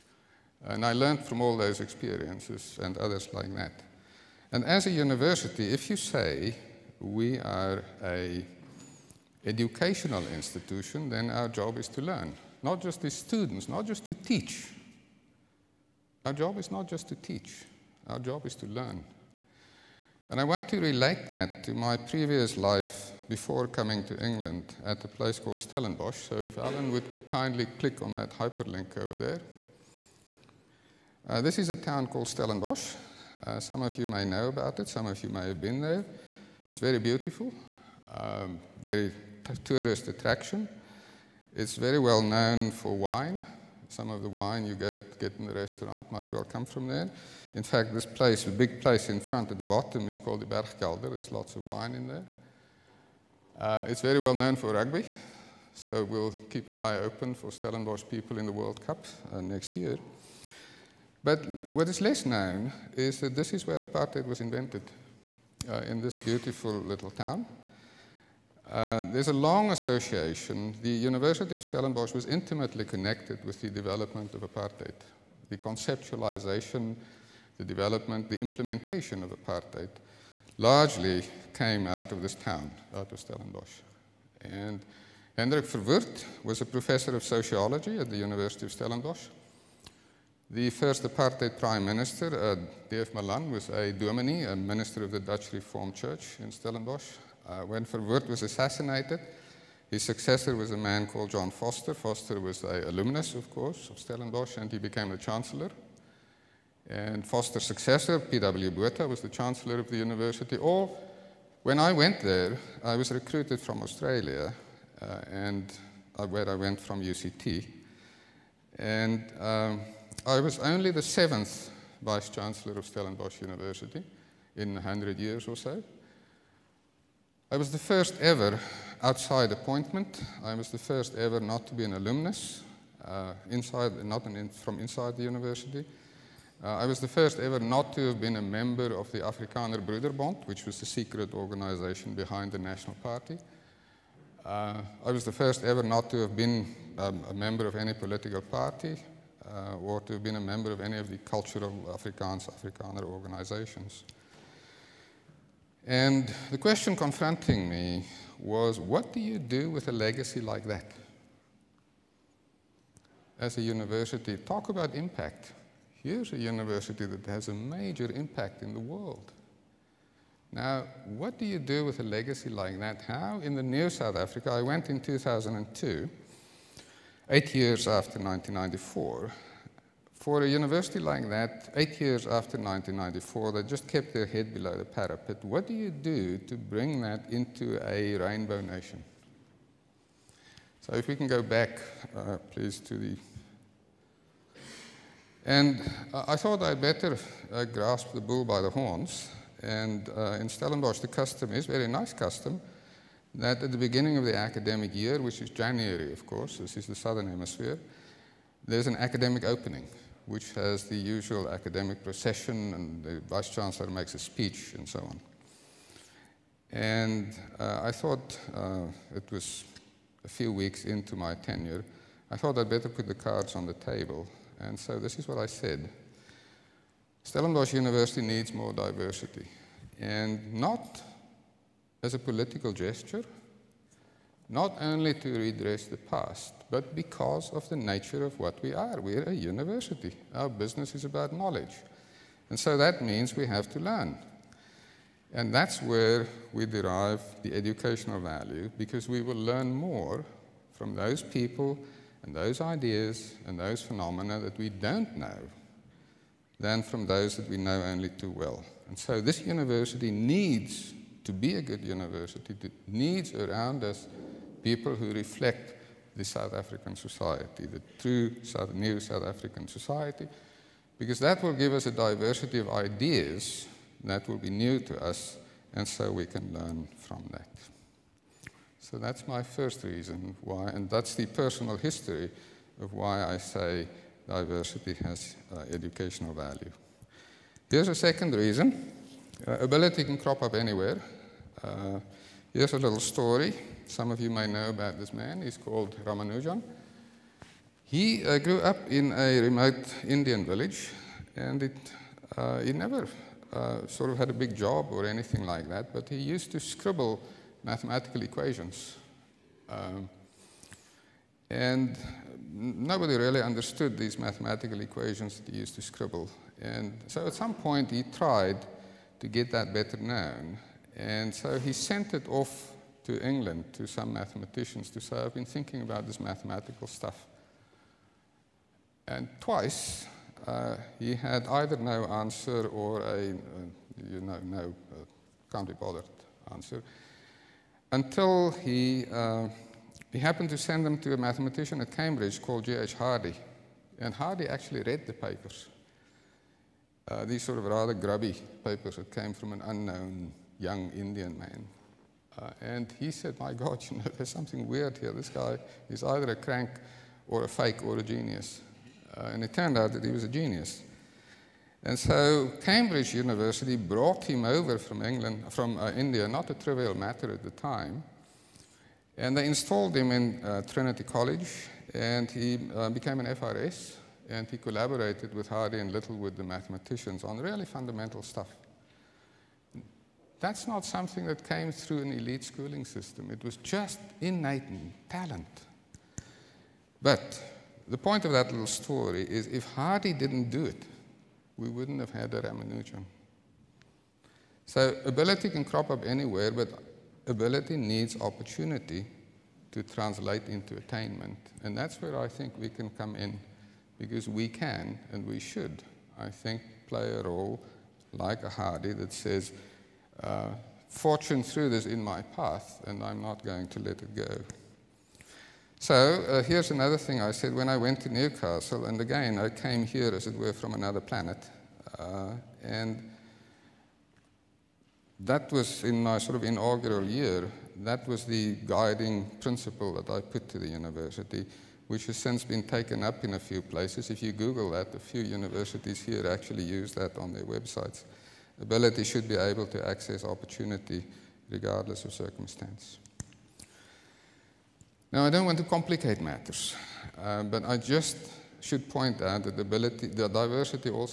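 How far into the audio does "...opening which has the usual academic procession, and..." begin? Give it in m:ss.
3:29.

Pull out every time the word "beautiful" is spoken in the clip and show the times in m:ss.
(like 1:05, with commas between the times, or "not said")
0:36, 1:06.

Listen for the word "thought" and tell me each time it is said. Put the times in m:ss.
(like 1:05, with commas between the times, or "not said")
3:16, 3:37, 3:42.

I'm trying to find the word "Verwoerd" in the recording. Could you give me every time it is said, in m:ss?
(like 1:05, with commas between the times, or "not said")
1:25, 1:37.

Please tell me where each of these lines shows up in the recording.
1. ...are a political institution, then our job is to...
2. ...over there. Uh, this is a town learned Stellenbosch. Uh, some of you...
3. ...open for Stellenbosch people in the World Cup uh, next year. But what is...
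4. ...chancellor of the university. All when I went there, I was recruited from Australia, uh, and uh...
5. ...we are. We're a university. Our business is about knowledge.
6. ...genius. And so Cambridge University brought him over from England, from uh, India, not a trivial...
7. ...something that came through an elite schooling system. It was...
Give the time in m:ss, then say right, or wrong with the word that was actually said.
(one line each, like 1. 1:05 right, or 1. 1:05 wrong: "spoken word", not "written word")
1. 0:07 wrong: "educational", not "political"
2. 0:29 wrong: "called", not "learned"
3. 0:56 right
4. 1:49 right
5. 3:58 right
6. 6:00 right
7. 6:20 right.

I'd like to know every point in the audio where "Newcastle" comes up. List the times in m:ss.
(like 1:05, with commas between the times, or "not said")
6:58.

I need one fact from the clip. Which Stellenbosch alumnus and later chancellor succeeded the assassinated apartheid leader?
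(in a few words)
John Vorster.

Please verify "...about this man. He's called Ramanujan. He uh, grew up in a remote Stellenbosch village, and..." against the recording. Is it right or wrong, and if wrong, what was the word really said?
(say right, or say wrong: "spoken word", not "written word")
wrong: "Indian", not "Stellenbosch".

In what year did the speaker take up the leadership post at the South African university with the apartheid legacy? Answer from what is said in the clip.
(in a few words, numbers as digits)
2002.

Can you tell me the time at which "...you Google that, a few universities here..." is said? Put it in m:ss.
7:14.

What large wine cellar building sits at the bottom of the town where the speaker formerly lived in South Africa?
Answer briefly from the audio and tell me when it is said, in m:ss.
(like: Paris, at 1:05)
Bergkelder, at 0:50.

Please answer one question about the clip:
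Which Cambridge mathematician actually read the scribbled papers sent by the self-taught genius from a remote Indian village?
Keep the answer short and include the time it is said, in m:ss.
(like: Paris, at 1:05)
J.H. Hardy, at 5:42.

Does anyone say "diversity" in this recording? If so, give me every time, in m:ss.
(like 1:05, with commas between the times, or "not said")
3:48, 4:31, 4:44, 7:30.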